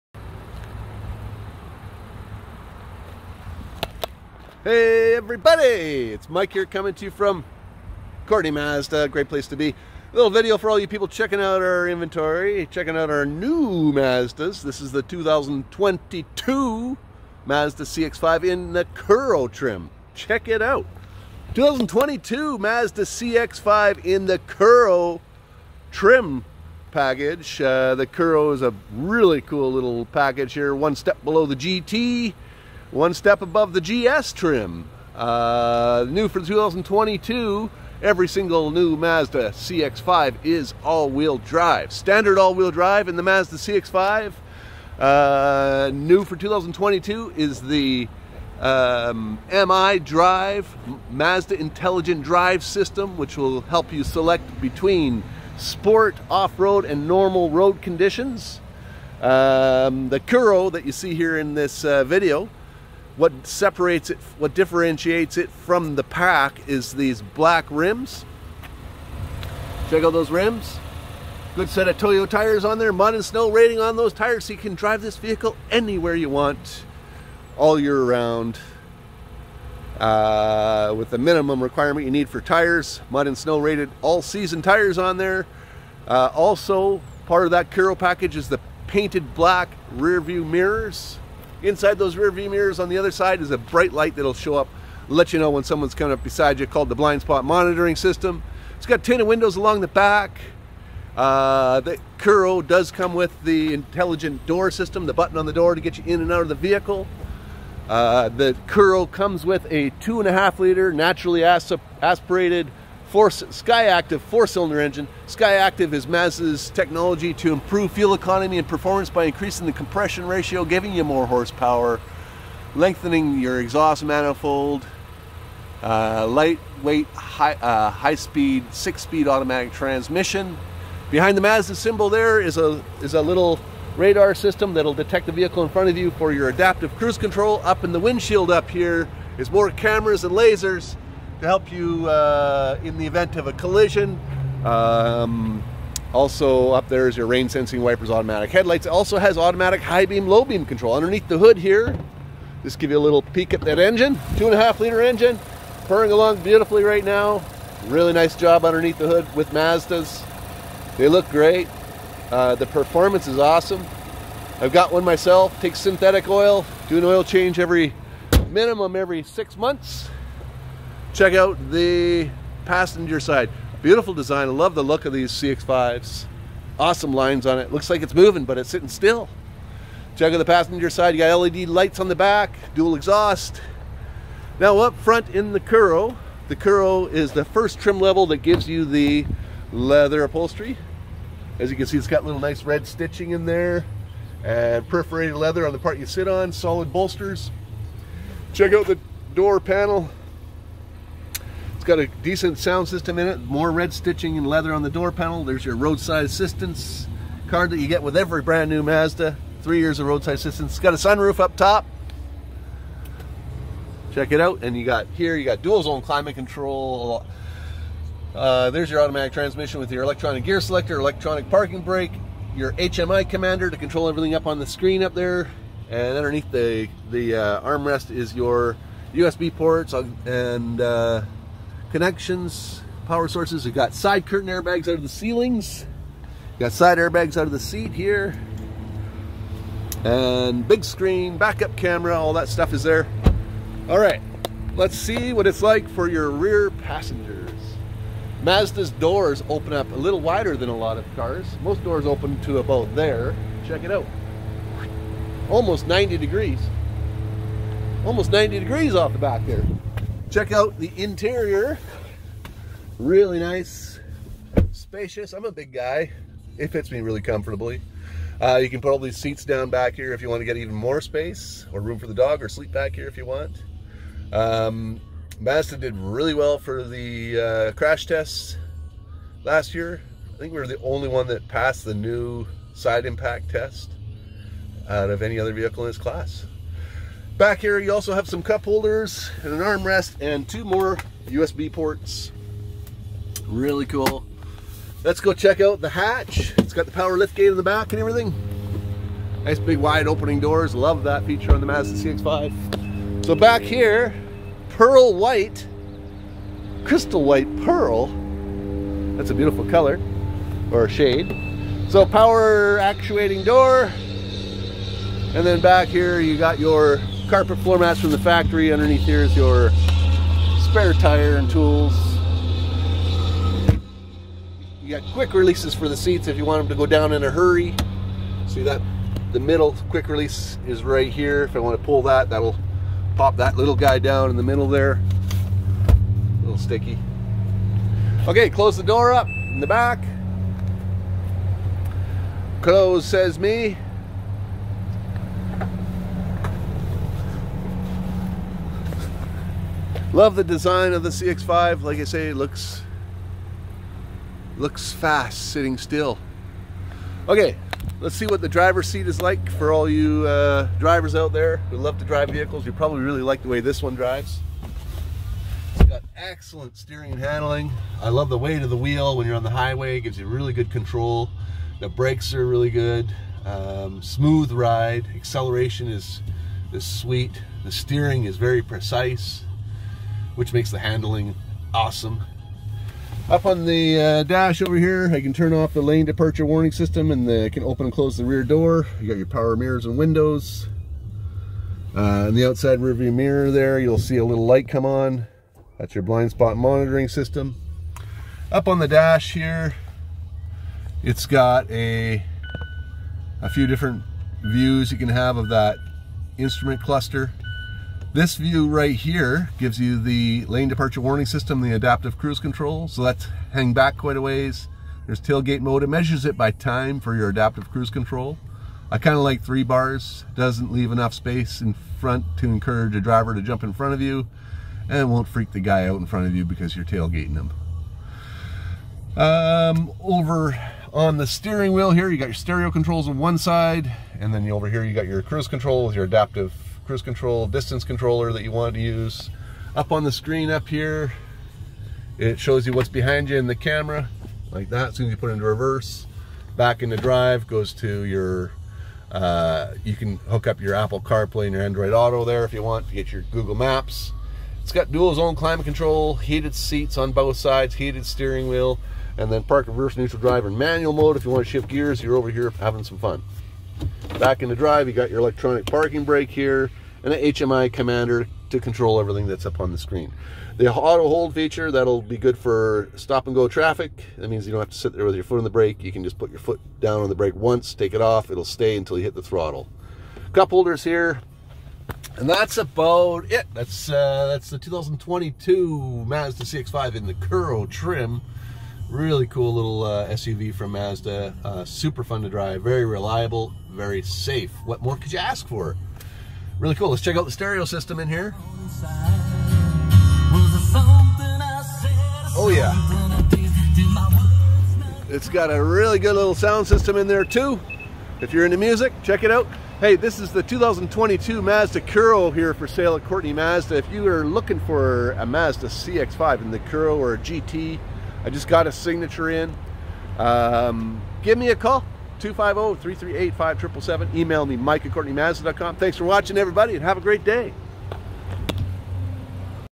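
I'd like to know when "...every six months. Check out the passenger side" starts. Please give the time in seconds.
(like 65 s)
168 s.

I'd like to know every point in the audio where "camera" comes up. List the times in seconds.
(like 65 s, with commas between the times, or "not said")
139 s, 241 s, 443 s.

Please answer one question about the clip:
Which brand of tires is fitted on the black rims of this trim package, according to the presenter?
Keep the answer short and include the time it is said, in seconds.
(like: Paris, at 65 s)
Toyo, at 71 s.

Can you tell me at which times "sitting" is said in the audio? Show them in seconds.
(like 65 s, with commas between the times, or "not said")
178 s, 355 s.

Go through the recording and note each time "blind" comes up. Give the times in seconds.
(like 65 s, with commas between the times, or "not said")
96 s, 396 s.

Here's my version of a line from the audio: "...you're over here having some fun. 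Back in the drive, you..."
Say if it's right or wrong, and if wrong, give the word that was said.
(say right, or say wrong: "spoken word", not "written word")
right.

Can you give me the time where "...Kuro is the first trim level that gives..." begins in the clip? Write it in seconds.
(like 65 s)
186 s.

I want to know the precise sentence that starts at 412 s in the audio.
So that's hang back quite a ways.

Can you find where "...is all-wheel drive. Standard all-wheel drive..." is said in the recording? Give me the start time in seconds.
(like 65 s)
40 s.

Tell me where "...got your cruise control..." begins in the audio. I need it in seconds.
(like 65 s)
434 s.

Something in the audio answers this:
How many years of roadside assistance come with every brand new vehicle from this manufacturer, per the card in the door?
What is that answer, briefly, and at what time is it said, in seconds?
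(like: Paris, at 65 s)
3, at 209 s.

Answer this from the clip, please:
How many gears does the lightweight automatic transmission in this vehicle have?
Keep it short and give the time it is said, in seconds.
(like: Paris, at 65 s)
6, at 128 s.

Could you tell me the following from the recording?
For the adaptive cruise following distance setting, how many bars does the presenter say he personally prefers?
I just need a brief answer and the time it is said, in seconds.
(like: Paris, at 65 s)
3, at 419 s.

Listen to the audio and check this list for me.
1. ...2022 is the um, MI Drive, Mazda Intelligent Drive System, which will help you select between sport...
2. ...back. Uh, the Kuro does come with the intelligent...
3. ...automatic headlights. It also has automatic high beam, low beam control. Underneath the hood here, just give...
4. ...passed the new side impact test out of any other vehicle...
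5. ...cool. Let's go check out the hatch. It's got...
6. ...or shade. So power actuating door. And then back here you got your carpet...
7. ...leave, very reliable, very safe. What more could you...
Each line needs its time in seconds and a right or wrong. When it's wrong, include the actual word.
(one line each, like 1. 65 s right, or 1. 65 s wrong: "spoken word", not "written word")
1. 46 s right
2. 99 s right
3. 148 s right
4. 281 s right
5. 293 s right
6. 310 s right
7. 492 s wrong: "drive", not "leave".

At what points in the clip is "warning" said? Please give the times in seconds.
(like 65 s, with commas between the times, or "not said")
386 s, 410 s.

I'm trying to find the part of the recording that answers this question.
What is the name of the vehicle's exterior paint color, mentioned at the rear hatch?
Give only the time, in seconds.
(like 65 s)
306 s.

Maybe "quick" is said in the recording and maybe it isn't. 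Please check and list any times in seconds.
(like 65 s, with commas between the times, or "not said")
325 s, 329 s.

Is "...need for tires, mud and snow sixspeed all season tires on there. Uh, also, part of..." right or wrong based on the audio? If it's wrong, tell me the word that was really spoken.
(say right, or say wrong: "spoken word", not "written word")
wrong: "rated", not "sixspeed".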